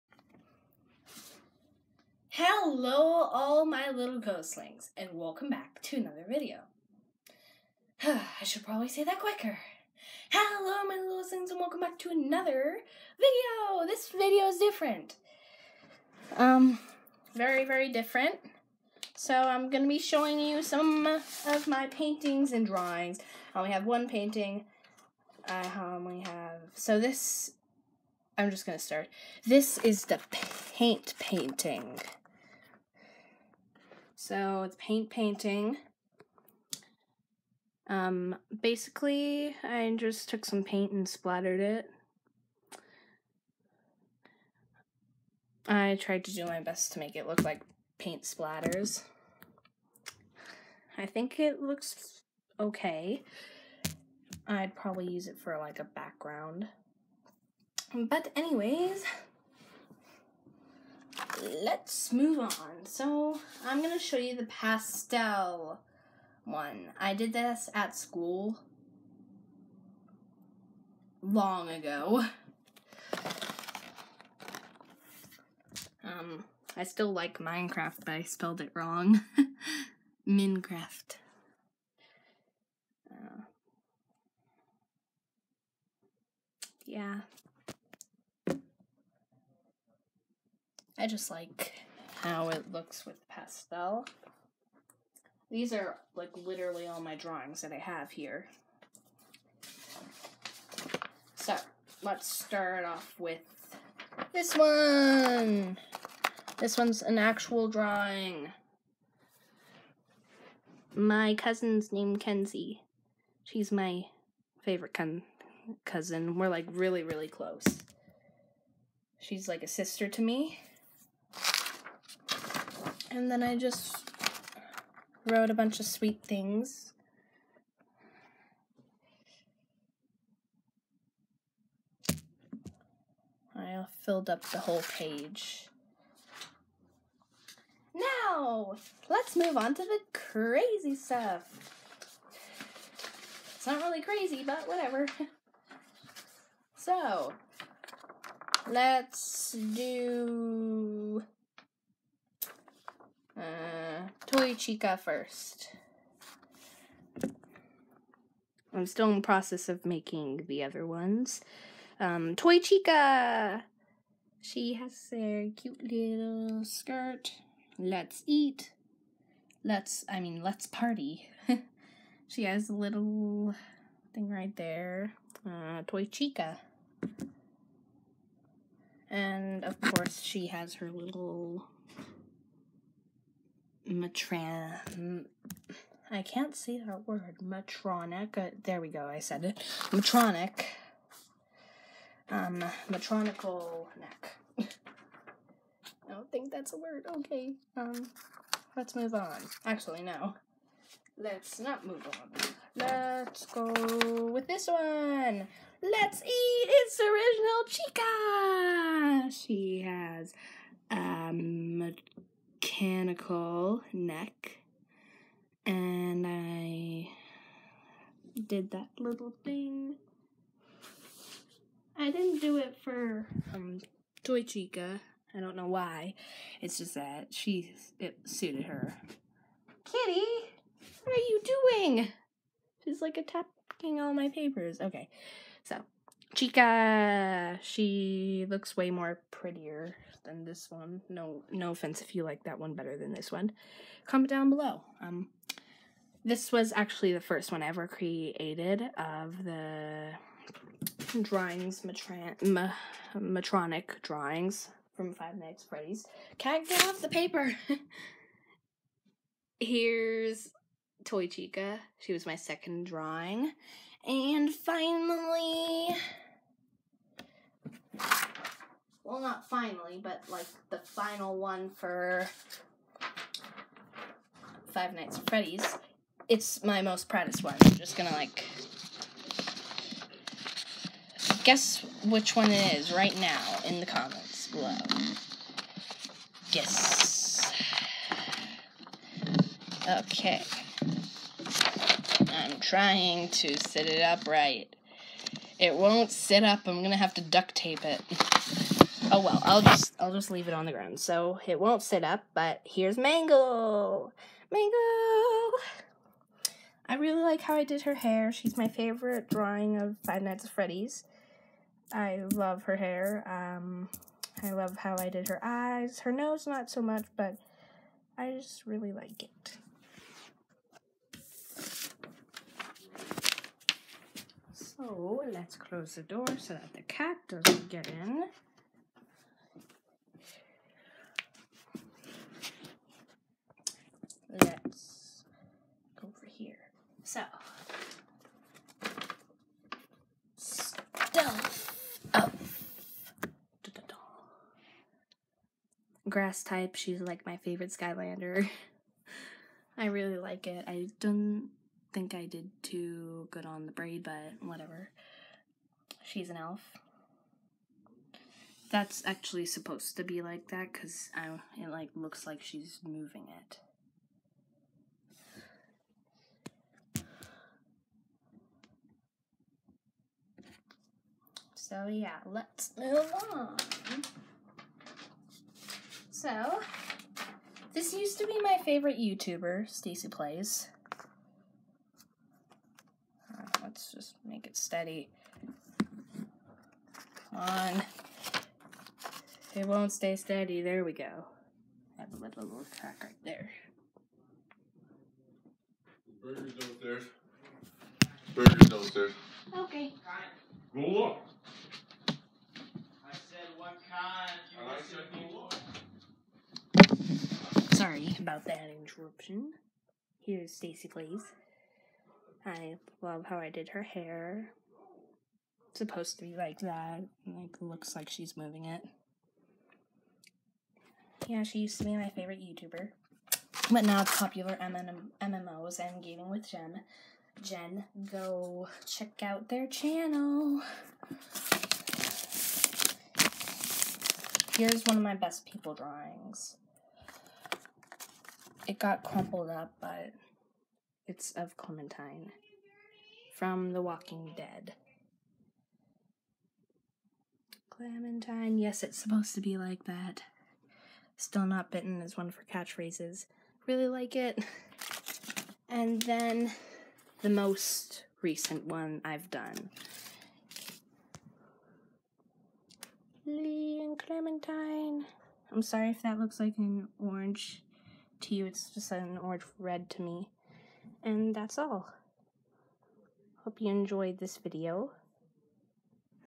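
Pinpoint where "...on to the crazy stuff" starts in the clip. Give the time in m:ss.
2:19.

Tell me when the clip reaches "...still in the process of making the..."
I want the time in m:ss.
2:38.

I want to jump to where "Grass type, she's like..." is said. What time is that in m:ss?
5:46.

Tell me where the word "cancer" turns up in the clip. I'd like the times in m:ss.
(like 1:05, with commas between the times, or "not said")
not said.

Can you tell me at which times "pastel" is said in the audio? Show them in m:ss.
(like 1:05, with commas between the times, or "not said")
1:04, 1:33.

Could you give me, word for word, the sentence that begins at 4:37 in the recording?
I'm just gonna like guess which one it is right now in the comments below.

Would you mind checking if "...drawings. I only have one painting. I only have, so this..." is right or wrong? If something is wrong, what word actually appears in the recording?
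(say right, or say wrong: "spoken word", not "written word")
right.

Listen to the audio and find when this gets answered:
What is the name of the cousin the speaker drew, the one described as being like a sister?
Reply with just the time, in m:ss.
1:52.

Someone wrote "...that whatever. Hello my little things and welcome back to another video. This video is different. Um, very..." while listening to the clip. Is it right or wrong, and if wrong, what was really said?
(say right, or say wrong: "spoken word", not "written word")
wrong: "quicker", not "whatever".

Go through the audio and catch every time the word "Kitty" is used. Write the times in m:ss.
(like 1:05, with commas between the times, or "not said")
3:49.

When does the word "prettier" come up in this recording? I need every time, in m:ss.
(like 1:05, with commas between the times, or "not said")
3:59.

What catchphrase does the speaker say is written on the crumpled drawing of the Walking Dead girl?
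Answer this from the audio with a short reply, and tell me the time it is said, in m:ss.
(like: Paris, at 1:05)
Still Not Bitten, at 7:31.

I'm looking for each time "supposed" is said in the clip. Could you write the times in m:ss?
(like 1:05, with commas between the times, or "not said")
5:59, 6:55, 7:28.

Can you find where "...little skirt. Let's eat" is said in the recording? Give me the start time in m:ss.
2:45.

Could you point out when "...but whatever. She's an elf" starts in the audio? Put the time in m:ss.
5:54.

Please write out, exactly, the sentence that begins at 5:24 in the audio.
So oh, let's close the door so that the cat doesn't get in.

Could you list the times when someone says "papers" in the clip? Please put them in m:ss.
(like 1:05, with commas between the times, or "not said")
3:54, 4:17.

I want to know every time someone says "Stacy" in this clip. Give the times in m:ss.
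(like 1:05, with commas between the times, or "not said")
6:19, 6:50.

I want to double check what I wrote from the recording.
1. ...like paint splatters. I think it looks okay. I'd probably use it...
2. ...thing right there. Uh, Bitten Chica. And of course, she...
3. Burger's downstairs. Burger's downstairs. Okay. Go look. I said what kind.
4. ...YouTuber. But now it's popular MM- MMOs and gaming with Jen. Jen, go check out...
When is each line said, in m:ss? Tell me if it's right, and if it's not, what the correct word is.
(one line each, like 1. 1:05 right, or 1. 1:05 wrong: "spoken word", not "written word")
1. 0:47 right
2. 2:54 wrong: "Toy", not "Bitten"
3. 6:36 right
4. 7:02 right.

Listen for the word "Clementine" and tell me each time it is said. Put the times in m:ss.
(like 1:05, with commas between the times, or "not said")
7:21, 7:27, 7:43.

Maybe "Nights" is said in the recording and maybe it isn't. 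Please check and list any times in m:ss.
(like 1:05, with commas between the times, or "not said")
4:15, 4:34, 5:10.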